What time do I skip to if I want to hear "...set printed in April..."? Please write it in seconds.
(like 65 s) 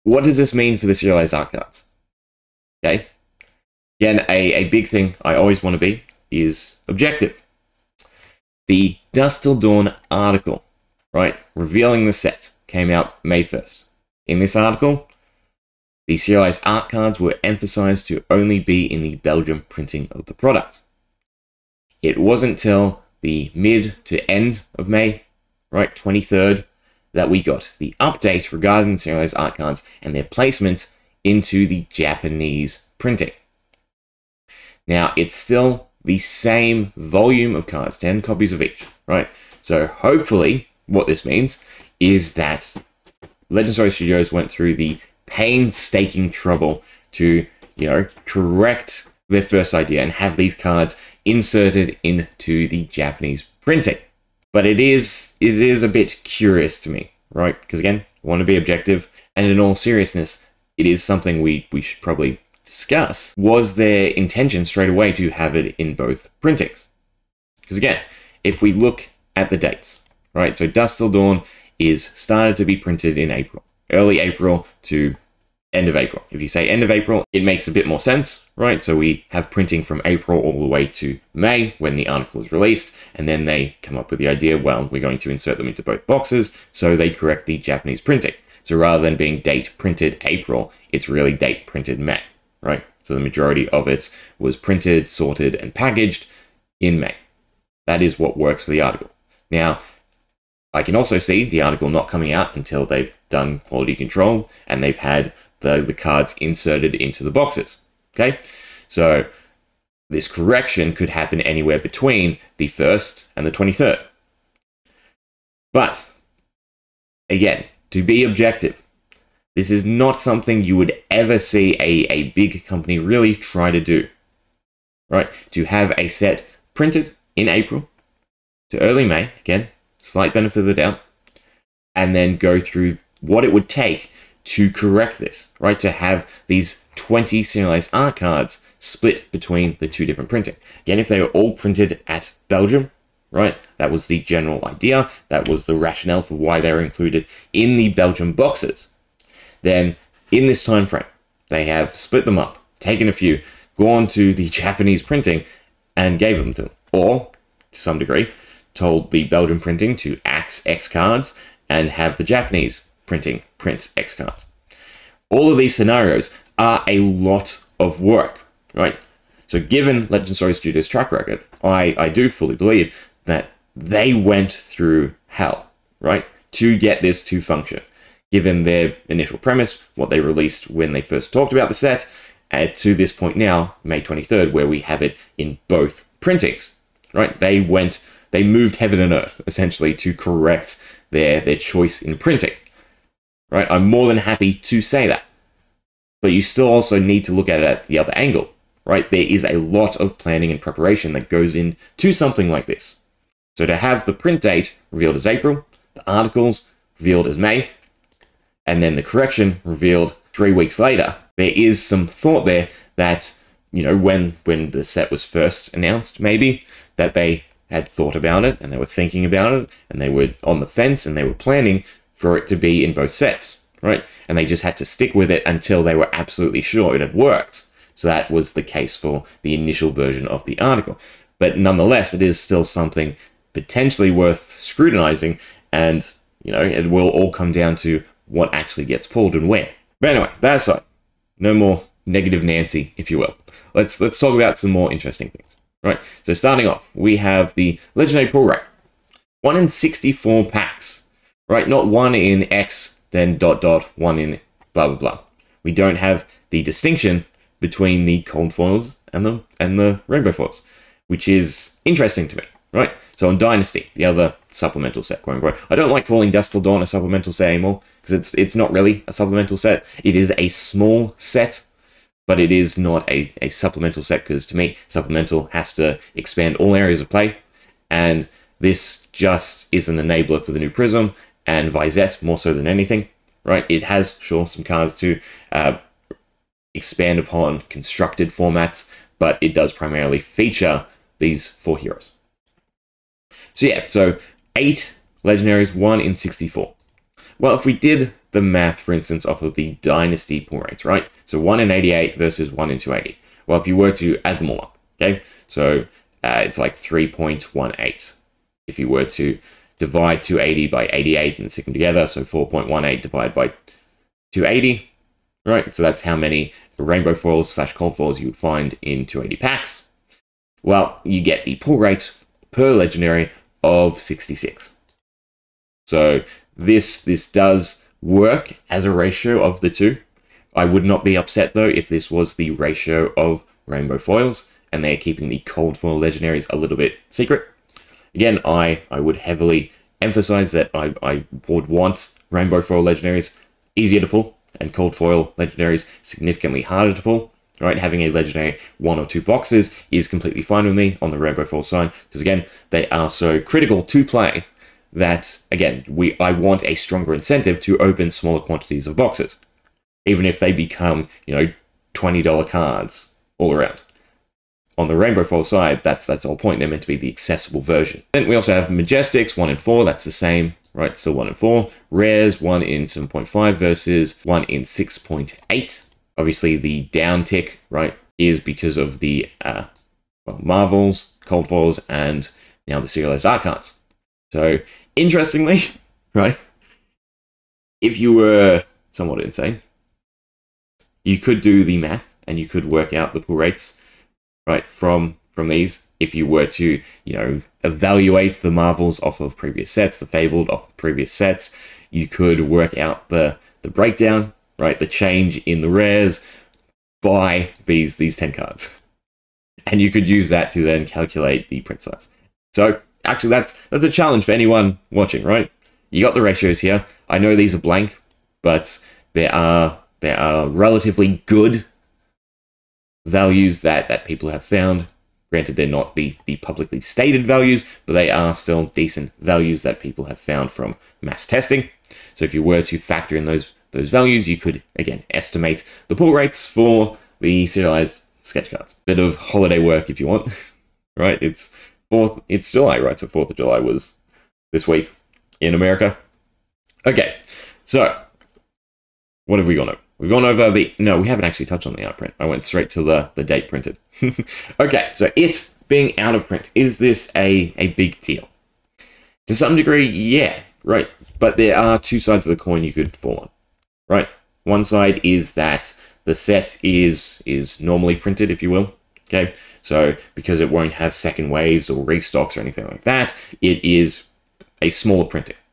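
126 s.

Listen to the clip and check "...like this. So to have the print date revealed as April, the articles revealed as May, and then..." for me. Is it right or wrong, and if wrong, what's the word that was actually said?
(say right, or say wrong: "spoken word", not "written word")
right.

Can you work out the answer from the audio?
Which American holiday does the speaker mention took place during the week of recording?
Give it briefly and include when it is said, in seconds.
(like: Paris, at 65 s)
Fourth of July, at 443 s.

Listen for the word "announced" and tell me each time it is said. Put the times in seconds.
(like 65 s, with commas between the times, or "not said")
215 s.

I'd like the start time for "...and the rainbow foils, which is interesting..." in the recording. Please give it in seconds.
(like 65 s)
259 s.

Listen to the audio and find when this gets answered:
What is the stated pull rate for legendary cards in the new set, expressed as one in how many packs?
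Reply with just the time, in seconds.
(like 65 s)
249 s.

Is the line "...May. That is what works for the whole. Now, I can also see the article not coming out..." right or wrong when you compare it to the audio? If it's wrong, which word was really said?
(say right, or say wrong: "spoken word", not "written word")
wrong: "article", not "whole".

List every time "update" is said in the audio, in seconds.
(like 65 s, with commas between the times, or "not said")
28 s.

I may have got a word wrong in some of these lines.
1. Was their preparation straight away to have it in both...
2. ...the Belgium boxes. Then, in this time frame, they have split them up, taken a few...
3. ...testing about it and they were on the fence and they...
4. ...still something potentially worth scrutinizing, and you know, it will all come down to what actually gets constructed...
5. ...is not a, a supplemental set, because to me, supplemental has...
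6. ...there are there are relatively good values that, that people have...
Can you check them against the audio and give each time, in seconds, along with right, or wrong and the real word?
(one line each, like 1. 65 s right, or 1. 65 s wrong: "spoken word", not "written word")
1. 63 s wrong: "intention", not "preparation"
2. 147 s right
3. 218 s wrong: "thinking", not "testing"
4. 232 s wrong: "pulled", not "constructed"
5. 272 s right
6. 419 s right.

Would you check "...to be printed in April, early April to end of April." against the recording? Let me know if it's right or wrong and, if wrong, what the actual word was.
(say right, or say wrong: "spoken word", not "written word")
right.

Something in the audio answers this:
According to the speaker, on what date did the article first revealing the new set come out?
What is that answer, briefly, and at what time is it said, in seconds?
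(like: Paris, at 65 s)
May 1st, at 13 s.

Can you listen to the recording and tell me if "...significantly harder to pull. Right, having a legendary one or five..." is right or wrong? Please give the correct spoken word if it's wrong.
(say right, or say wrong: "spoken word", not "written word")
wrong: "two", not "five".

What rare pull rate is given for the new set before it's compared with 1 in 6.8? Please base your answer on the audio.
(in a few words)
1 in 7.5.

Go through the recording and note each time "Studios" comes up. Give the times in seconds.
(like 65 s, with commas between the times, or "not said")
43 s, 170 s.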